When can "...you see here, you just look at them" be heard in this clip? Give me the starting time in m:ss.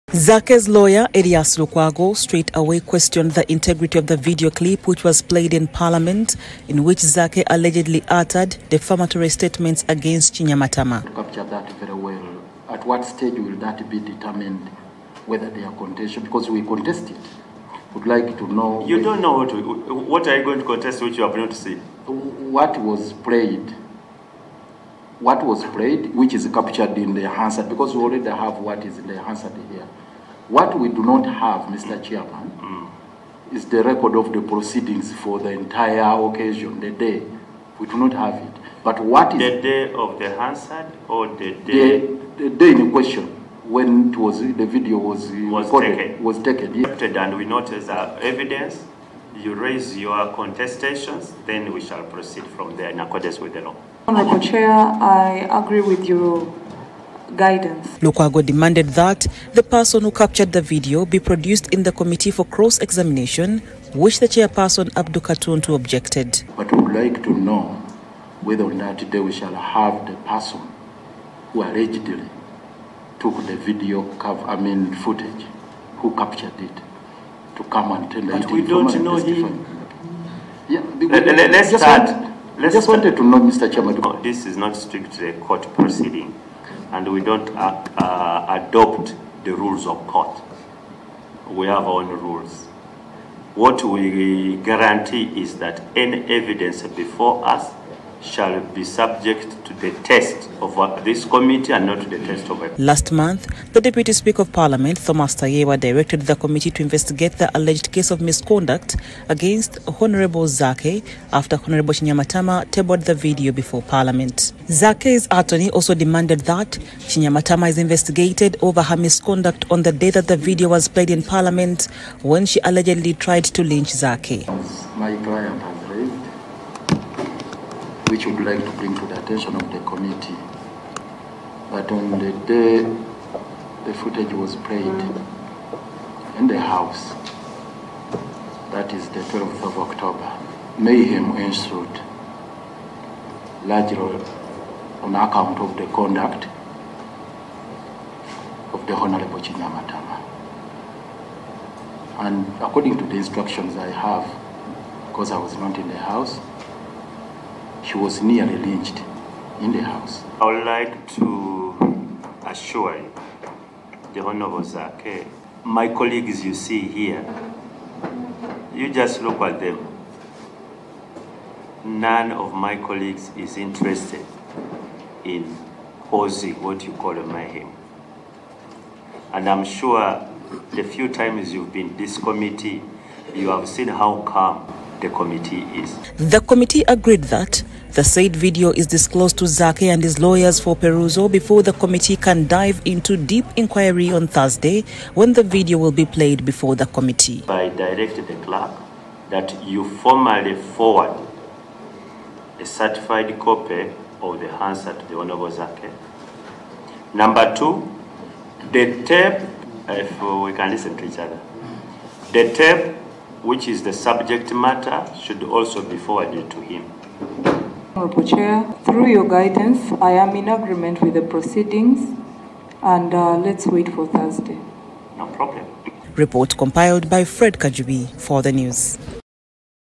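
2:46.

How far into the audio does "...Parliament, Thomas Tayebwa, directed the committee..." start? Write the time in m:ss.
1:44.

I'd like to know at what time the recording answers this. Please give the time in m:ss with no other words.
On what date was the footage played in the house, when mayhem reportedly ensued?
2:19.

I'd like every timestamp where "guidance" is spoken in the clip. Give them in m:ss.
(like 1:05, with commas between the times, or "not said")
0:57, 3:39.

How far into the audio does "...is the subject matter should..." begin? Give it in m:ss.
3:33.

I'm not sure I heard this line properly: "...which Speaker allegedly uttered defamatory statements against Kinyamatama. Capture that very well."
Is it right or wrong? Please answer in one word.
wrong.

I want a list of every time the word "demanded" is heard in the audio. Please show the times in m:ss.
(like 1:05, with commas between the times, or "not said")
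0:58, 1:55.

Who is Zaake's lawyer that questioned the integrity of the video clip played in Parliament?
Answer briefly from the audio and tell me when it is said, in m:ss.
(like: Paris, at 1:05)
Erias Lukwago, at 0:01.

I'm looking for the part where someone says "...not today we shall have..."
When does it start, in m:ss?
1:08.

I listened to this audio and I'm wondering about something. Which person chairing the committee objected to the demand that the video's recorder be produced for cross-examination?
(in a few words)
Abdul Katuntu.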